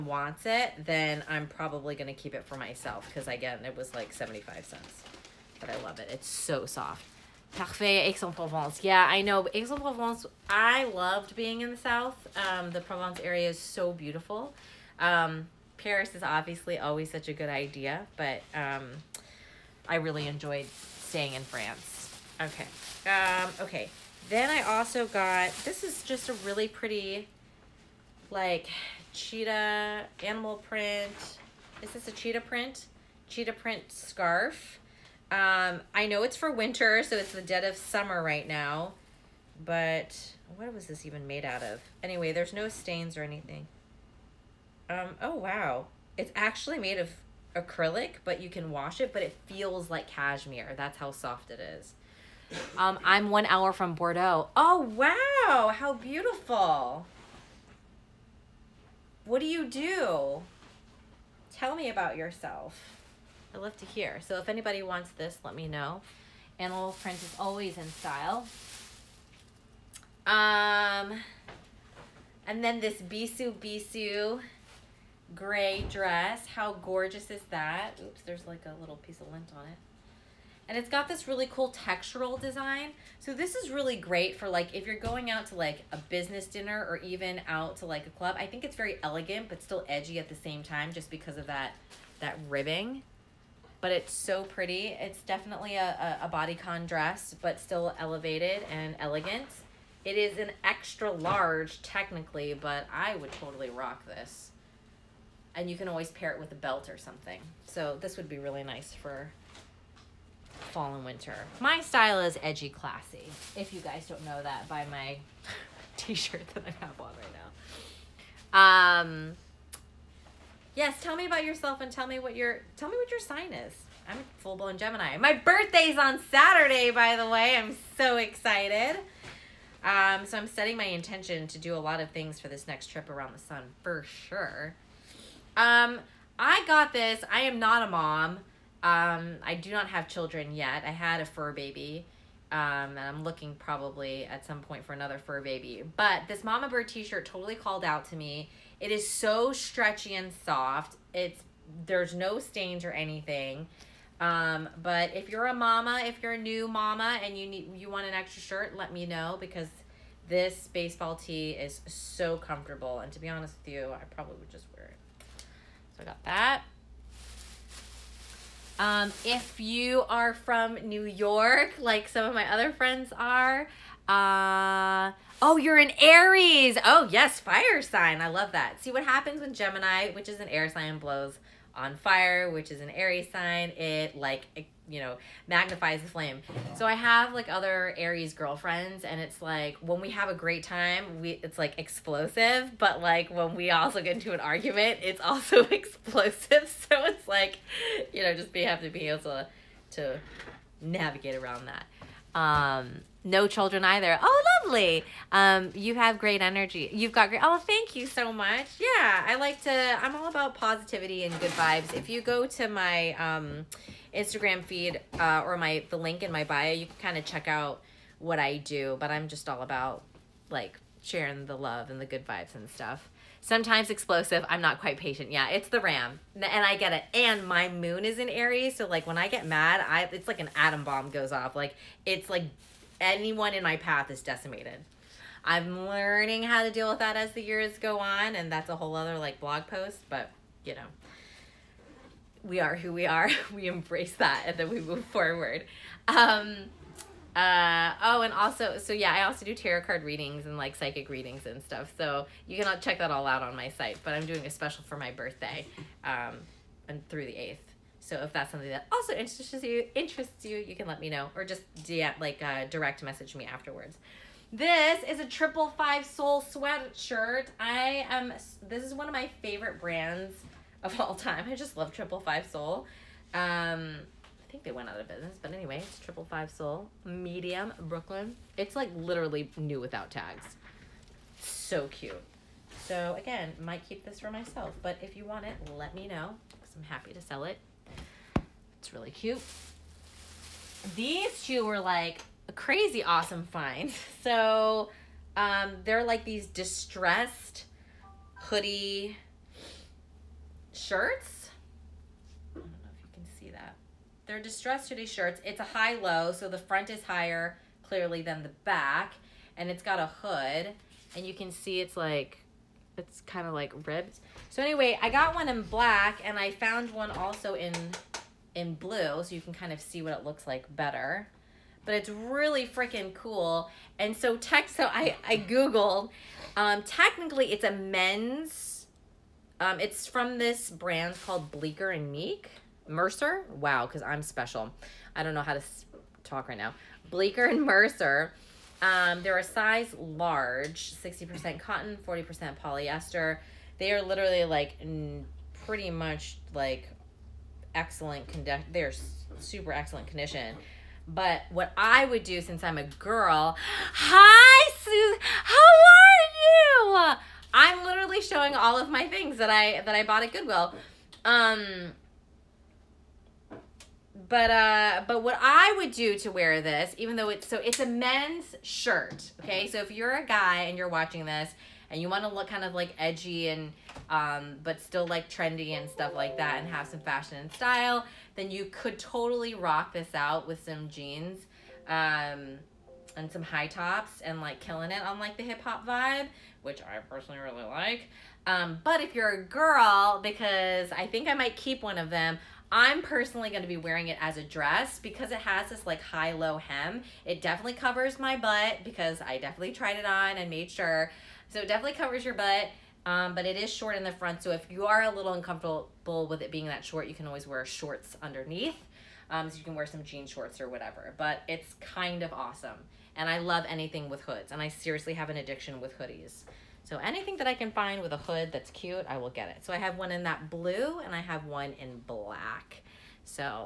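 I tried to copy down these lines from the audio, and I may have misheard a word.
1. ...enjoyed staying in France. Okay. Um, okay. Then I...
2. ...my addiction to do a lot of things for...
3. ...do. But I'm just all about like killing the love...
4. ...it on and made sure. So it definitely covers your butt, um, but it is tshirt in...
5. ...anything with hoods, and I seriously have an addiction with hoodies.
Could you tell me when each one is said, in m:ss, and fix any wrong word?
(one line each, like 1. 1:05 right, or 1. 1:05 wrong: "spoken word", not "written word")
1. 0:20 right
2. 2:10 wrong: "intention", not "addiction"
3. 3:38 wrong: "sharing", not "killing"
4. 6:39 wrong: "short", not "tshirt"
5. 6:53 right.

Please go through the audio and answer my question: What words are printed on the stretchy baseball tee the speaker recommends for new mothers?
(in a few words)
Mama Bird.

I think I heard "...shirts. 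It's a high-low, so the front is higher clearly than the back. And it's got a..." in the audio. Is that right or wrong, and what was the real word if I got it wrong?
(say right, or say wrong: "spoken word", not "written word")
right.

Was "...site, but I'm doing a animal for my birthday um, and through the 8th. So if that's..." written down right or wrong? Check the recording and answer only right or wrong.
wrong.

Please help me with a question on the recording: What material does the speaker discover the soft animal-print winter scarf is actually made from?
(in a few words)
Acrylic.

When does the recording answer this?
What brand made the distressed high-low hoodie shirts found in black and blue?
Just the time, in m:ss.
5:37.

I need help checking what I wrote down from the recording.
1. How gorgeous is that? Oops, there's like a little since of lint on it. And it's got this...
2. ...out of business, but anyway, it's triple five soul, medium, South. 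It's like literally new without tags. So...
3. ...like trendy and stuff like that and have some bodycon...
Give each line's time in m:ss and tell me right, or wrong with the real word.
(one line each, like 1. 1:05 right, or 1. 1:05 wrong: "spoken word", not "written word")
1. 1:16 wrong: "piece", not "since"
2. 4:34 wrong: "Brooklyn", not "South"
3. 6:15 wrong: "fashion", not "bodycon".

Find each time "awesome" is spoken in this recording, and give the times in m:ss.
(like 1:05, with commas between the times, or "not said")
4:53, 6:52.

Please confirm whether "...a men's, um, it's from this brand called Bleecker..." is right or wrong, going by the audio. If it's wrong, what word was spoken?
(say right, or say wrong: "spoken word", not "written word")
right.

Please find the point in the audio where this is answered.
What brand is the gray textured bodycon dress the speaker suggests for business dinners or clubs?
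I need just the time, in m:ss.
1:12.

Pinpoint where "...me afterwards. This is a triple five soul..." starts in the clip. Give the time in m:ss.
4:23.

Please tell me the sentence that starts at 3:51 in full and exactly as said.
Like it's like anyone in my path is decimated.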